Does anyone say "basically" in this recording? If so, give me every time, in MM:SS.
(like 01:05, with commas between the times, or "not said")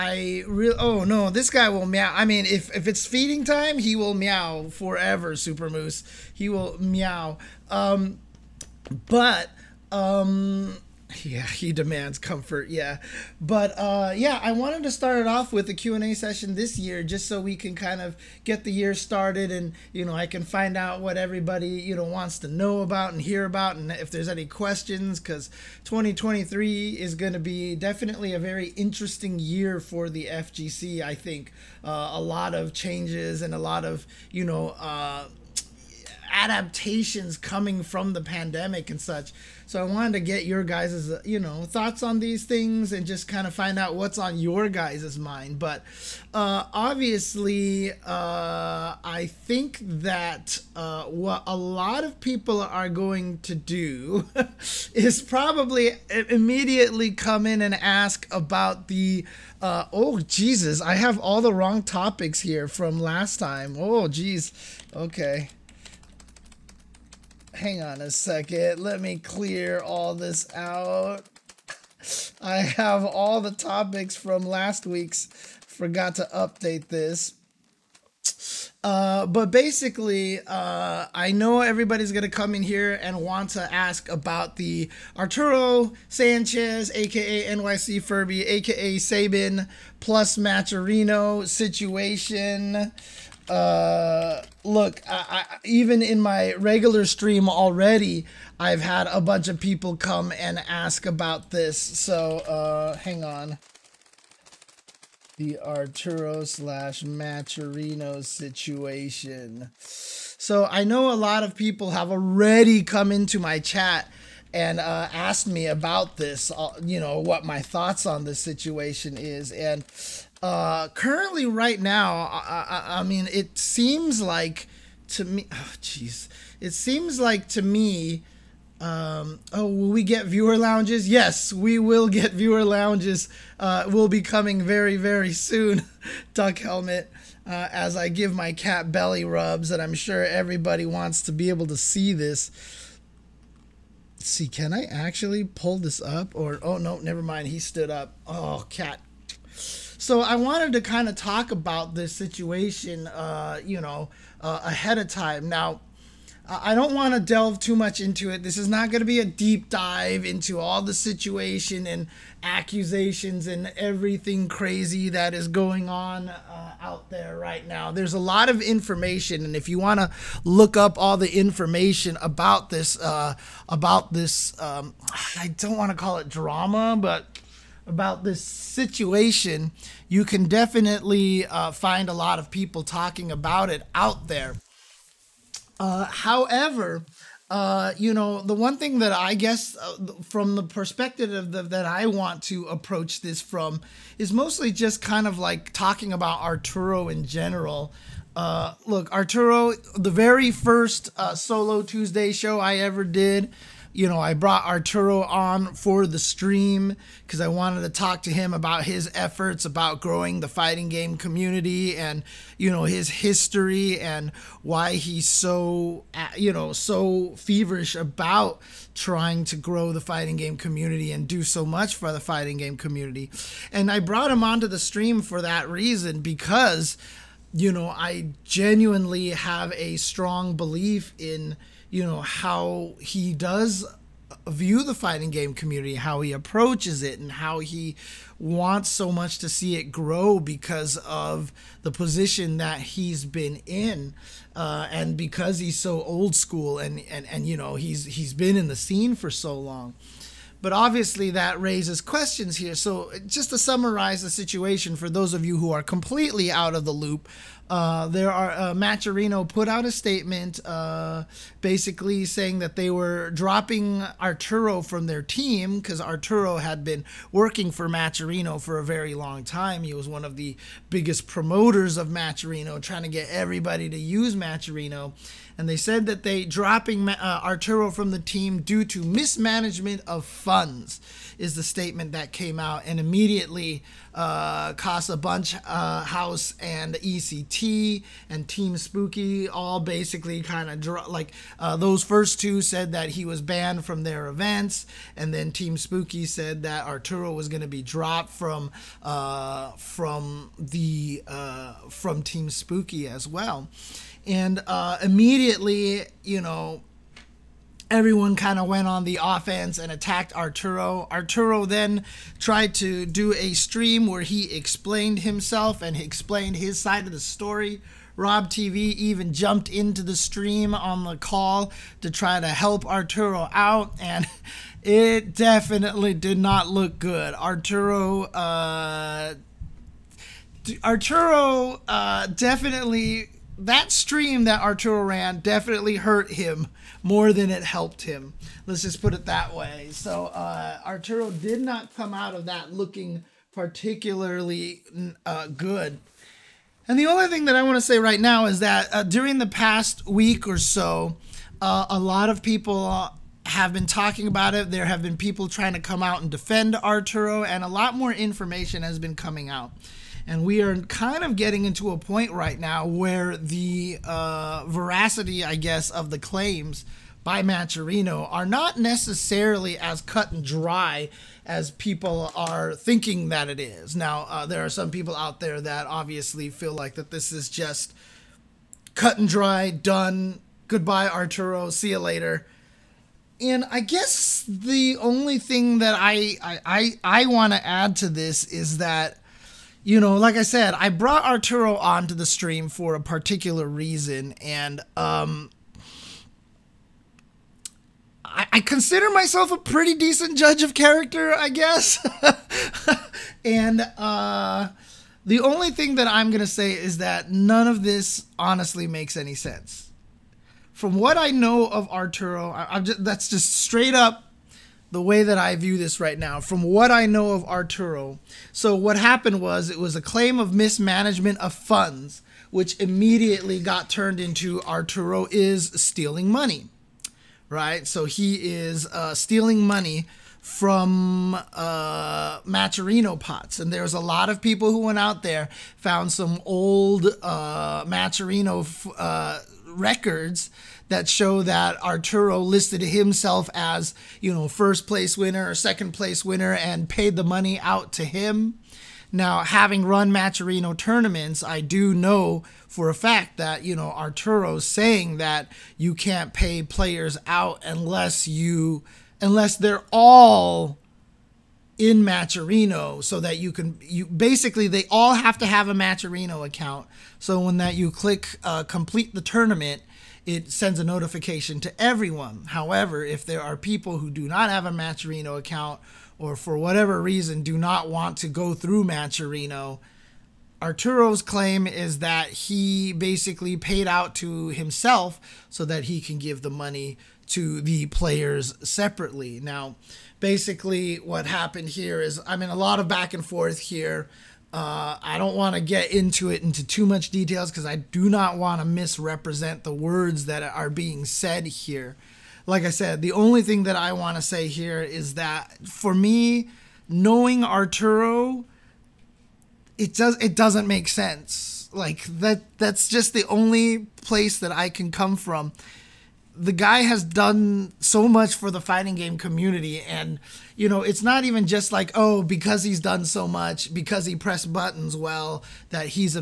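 01:19, 04:21, 04:49, 07:44, 08:02, 08:10.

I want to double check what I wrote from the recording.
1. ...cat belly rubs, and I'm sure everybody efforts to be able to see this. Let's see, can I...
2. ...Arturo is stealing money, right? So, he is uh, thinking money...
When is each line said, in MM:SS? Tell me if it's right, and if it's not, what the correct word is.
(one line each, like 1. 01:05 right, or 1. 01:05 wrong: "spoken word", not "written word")
1. 02:18 wrong: "wants", not "efforts"
2. 07:04 wrong: "stealing", not "thinking".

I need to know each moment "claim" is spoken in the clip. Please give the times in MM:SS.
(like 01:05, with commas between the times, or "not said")
06:06, 07:00, 08:01.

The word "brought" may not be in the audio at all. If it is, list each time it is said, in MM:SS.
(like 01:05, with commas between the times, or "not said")
03:24, 03:43, 06:30.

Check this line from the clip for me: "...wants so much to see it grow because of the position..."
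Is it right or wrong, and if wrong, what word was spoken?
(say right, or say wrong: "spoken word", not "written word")
right.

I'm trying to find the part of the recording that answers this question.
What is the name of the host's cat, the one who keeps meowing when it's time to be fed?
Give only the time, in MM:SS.
00:05.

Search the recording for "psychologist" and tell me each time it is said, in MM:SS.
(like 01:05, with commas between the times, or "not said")
not said.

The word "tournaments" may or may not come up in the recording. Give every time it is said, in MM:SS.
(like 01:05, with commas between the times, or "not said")
07:30, 07:49.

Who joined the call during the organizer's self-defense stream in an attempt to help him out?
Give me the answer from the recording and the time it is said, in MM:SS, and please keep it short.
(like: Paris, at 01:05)
Rob TV, at 05:18.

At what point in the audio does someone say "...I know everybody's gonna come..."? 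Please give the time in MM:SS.
01:21.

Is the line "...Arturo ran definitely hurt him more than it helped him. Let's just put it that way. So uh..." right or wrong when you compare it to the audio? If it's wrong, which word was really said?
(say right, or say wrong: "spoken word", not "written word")
right.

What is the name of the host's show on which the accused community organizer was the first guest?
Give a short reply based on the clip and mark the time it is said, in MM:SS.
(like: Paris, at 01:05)
Solo Tuesday, at 03:21.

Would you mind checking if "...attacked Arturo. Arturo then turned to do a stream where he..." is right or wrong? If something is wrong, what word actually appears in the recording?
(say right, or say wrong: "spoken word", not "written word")
wrong: "tried", not "turned".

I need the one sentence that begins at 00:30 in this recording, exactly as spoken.
I think uh, a lot of changes and a lot of you know.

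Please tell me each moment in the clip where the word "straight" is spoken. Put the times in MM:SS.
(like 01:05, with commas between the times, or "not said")
06:53.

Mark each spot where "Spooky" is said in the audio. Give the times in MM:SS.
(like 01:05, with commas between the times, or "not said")
04:48, 04:55, 05:02.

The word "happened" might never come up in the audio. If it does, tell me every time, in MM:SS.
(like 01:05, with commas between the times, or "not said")
06:58, 08:11.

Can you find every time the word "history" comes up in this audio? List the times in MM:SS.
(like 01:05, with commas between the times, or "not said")
03:33.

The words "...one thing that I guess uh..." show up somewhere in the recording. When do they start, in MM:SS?
03:08.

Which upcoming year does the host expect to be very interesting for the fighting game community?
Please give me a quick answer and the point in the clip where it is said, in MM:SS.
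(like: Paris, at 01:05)
2023, at 00:25.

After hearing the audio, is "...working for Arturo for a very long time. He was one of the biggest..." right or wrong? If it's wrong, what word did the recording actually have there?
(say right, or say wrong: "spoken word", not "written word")
wrong: "Matcherino", not "Arturo".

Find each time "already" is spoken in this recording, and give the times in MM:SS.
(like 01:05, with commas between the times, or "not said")
01:37, 01:52.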